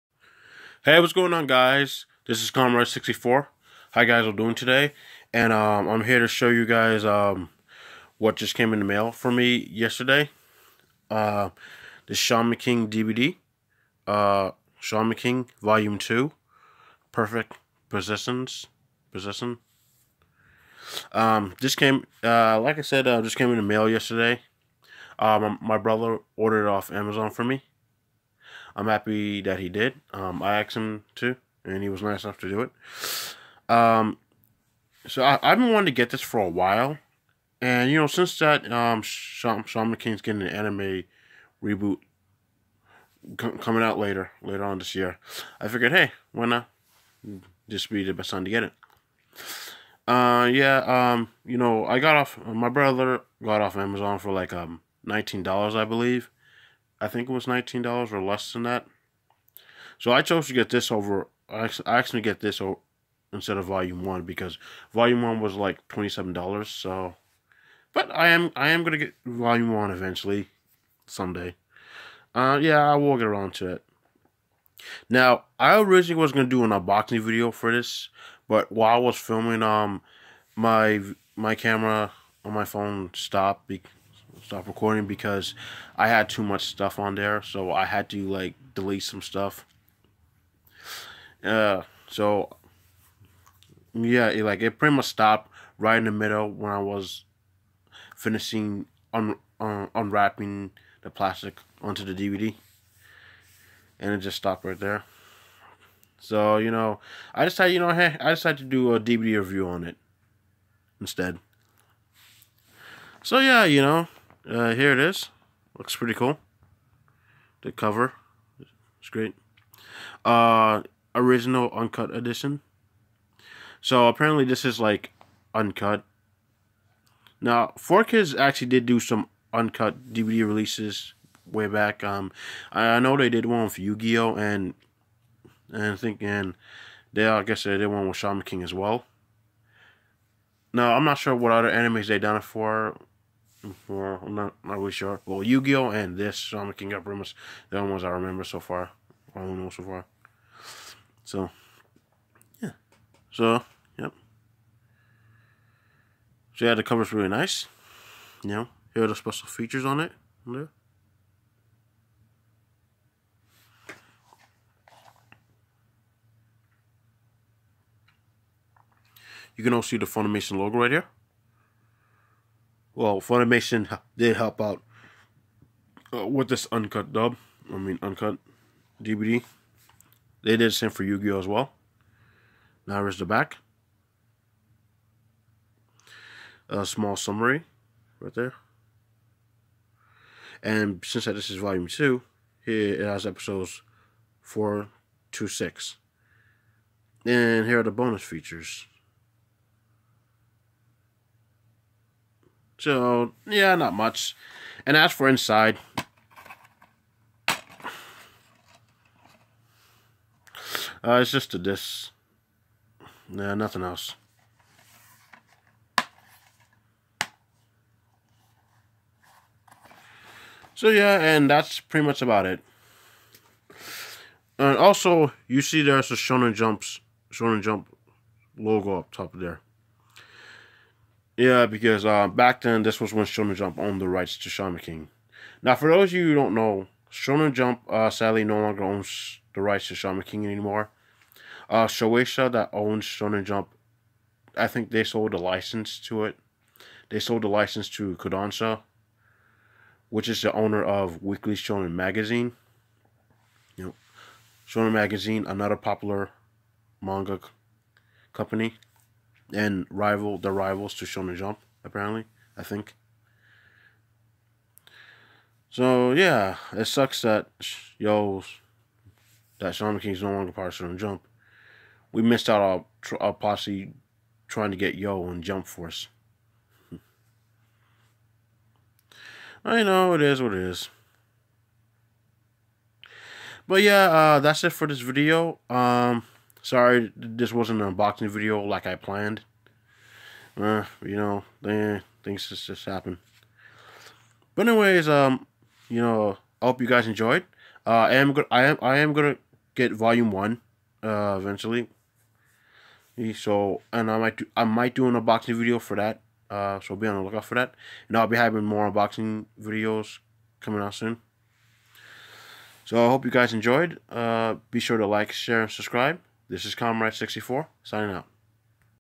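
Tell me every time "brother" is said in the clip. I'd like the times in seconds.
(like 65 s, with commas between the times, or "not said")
25 s, 52 s.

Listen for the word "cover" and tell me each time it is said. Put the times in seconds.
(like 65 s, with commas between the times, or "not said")
117 s, 156 s.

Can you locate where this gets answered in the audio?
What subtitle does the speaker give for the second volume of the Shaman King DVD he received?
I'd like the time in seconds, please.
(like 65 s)
17 s.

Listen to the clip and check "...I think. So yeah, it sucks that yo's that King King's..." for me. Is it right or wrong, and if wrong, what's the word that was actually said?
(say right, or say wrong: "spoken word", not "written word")
right.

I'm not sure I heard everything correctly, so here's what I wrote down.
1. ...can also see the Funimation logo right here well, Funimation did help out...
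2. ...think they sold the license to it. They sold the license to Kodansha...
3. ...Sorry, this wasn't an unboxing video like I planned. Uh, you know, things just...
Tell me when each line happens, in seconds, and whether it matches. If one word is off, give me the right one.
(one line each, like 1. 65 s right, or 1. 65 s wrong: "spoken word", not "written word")
1. 169 s right
2. 244 s right
3. 286 s right.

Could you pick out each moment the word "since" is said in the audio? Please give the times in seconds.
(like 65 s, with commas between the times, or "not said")
38 s, 191 s.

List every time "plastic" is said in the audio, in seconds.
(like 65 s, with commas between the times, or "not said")
101 s.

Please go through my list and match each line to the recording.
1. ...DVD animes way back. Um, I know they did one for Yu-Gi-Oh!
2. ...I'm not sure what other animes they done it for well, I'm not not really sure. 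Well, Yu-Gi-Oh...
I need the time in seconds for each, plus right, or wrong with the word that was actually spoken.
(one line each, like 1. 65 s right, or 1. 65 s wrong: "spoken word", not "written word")
1. 130 s wrong: "releases", not "animes"
2. 140 s right.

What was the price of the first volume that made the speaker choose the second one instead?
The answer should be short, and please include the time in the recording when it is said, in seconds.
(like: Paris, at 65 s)
$27, at 65 s.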